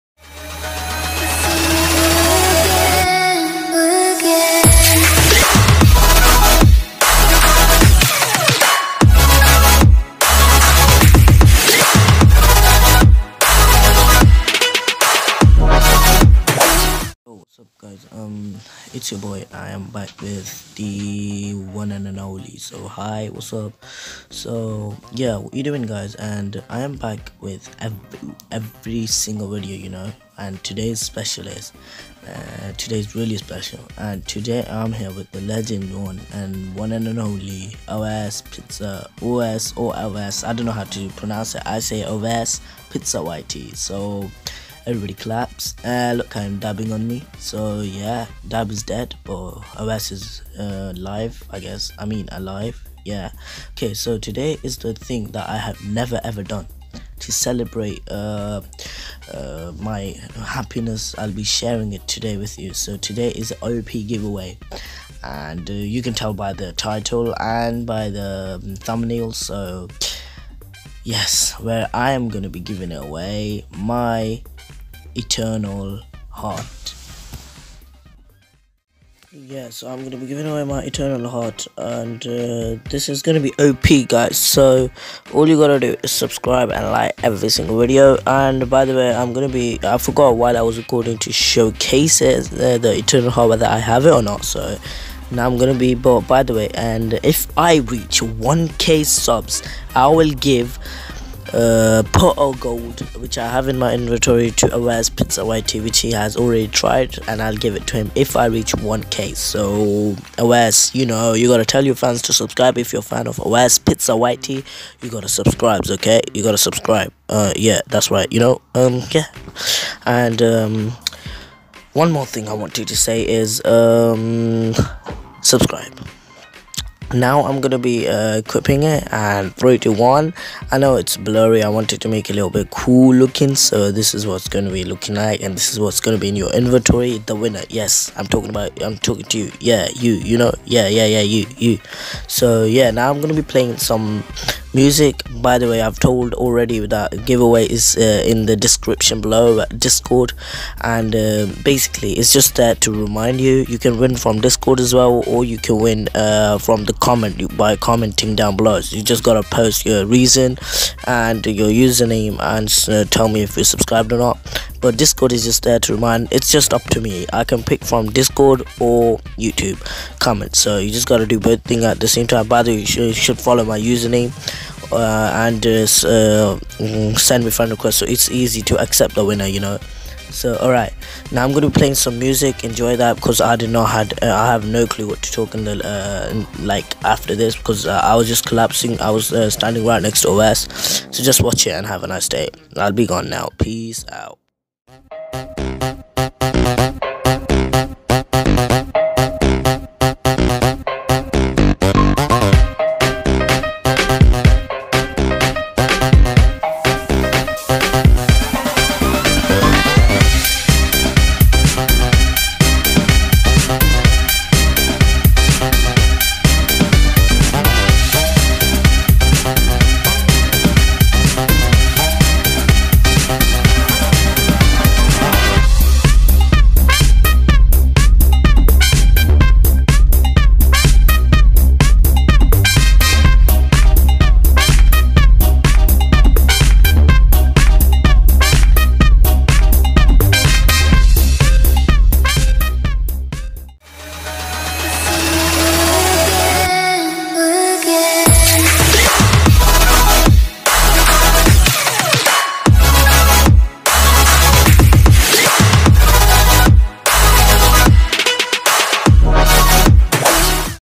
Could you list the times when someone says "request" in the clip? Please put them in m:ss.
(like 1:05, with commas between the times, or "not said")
2:57.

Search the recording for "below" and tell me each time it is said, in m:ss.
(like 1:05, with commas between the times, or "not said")
2:29, 2:38.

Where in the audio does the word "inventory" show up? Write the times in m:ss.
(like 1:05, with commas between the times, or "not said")
1:43, 2:16.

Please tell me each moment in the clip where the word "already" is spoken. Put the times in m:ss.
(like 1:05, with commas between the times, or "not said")
1:46, 2:26.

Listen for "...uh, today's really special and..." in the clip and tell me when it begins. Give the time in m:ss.
0:32.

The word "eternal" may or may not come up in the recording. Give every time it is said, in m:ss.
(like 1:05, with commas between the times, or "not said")
1:15, 1:20, 1:32.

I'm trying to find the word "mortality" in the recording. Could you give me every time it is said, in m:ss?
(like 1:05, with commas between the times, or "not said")
not said.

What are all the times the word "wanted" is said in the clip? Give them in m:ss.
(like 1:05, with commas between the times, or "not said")
2:02, 2:11.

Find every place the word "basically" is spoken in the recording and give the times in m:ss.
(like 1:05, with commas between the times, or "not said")
2:31.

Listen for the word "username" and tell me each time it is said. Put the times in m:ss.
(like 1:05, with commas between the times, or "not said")
2:41, 2:53.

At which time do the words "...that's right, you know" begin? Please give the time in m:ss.
1:57.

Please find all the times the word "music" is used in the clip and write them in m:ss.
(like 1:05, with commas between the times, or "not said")
2:24, 3:02.